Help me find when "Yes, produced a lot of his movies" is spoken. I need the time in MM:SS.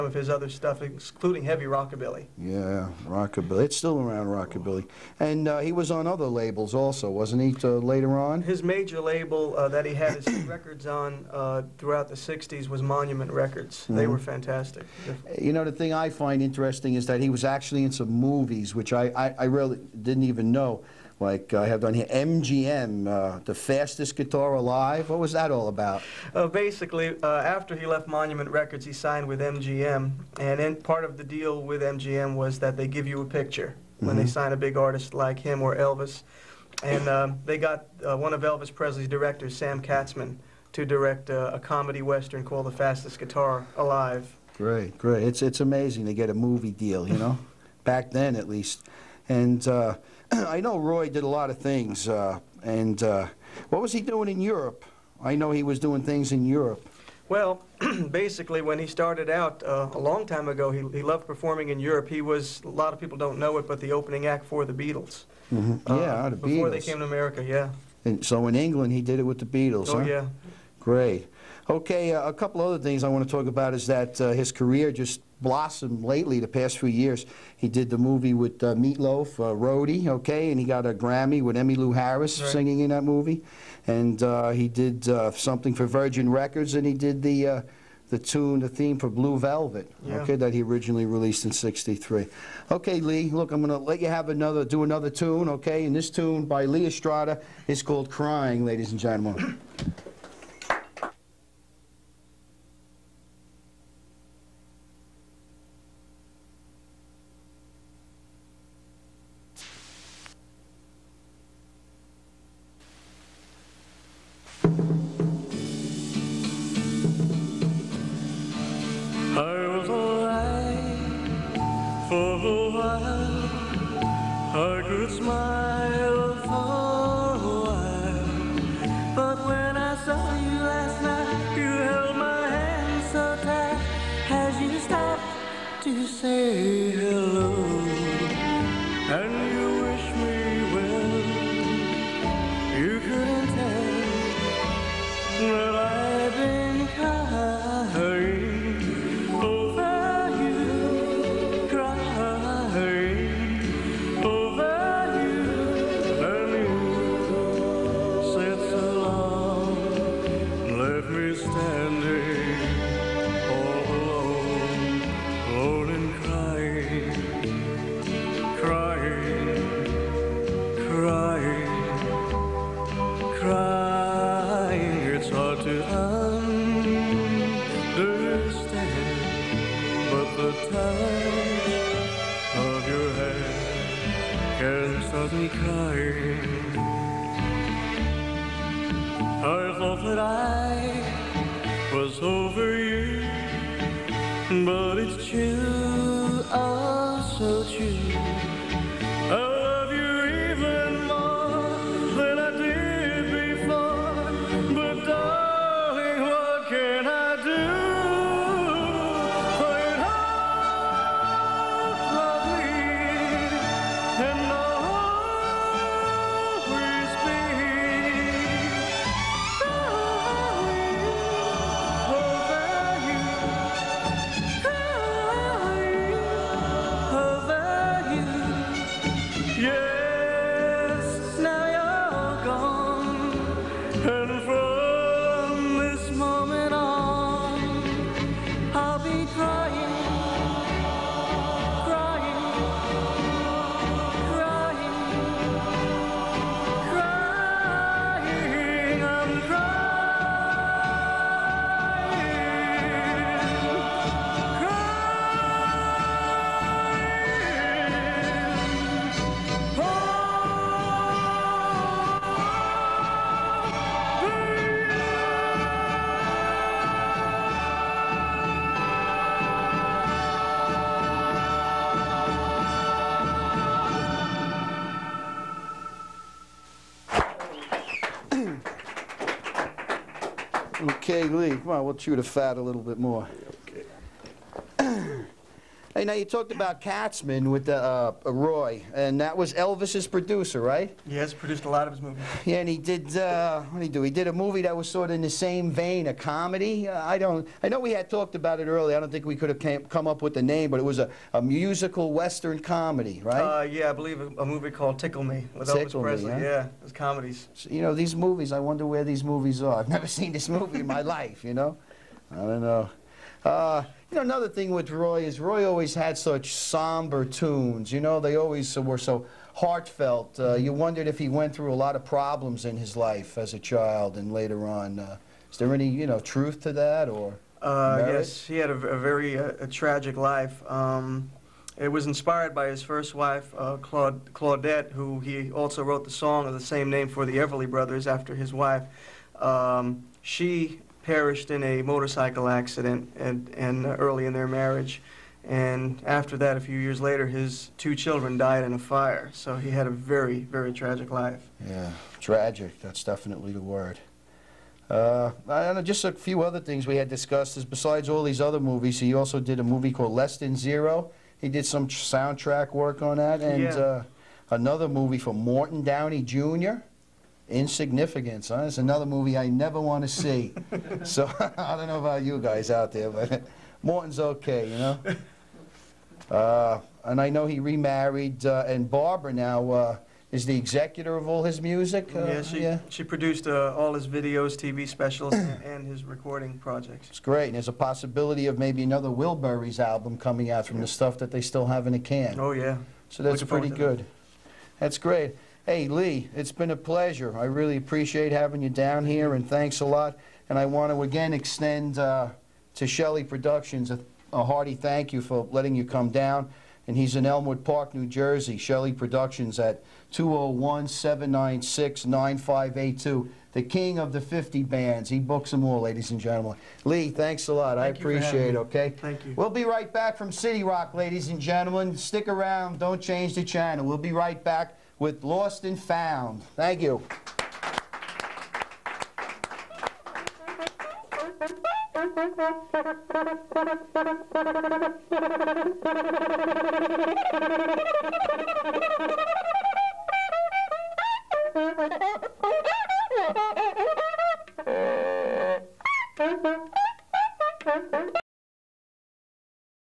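04:51.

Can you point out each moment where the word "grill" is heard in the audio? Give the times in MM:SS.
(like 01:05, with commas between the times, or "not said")
not said.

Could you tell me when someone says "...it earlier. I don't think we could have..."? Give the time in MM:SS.
04:58.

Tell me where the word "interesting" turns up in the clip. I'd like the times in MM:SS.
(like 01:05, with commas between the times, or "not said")
00:16.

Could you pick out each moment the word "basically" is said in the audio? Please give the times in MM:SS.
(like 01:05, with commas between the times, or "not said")
00:26, 00:58.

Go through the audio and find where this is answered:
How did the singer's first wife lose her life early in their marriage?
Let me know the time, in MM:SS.
05:41.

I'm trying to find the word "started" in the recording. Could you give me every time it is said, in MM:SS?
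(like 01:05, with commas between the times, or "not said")
00:58.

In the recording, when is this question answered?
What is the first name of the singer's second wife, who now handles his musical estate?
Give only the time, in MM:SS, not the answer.
06:18.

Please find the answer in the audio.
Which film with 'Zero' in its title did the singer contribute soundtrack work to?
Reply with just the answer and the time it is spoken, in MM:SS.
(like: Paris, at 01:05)
Less Than Zero, at 06:00.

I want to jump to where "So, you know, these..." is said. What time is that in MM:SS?
05:07.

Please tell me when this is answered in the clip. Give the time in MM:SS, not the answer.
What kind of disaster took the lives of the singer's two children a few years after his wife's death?
05:48.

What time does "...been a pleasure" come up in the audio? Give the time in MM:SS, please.
06:36.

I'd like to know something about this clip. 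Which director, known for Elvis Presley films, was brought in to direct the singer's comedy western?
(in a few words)
Sam Katzman.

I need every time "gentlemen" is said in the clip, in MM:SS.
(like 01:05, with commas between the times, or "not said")
01:38, 06:56, 07:01.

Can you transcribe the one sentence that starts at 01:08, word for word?
And so in England, he did it with the Beatles, Oh, huh?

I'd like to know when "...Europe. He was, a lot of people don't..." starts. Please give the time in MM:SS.
01:01.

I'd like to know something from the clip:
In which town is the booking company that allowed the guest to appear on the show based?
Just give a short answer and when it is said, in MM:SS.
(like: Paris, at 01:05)
Elmwood Park, at 06:47.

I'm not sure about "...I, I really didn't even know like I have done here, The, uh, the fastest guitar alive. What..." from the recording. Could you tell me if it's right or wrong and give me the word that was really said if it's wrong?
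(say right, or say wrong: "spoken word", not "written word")
wrong: "MGM", not "The".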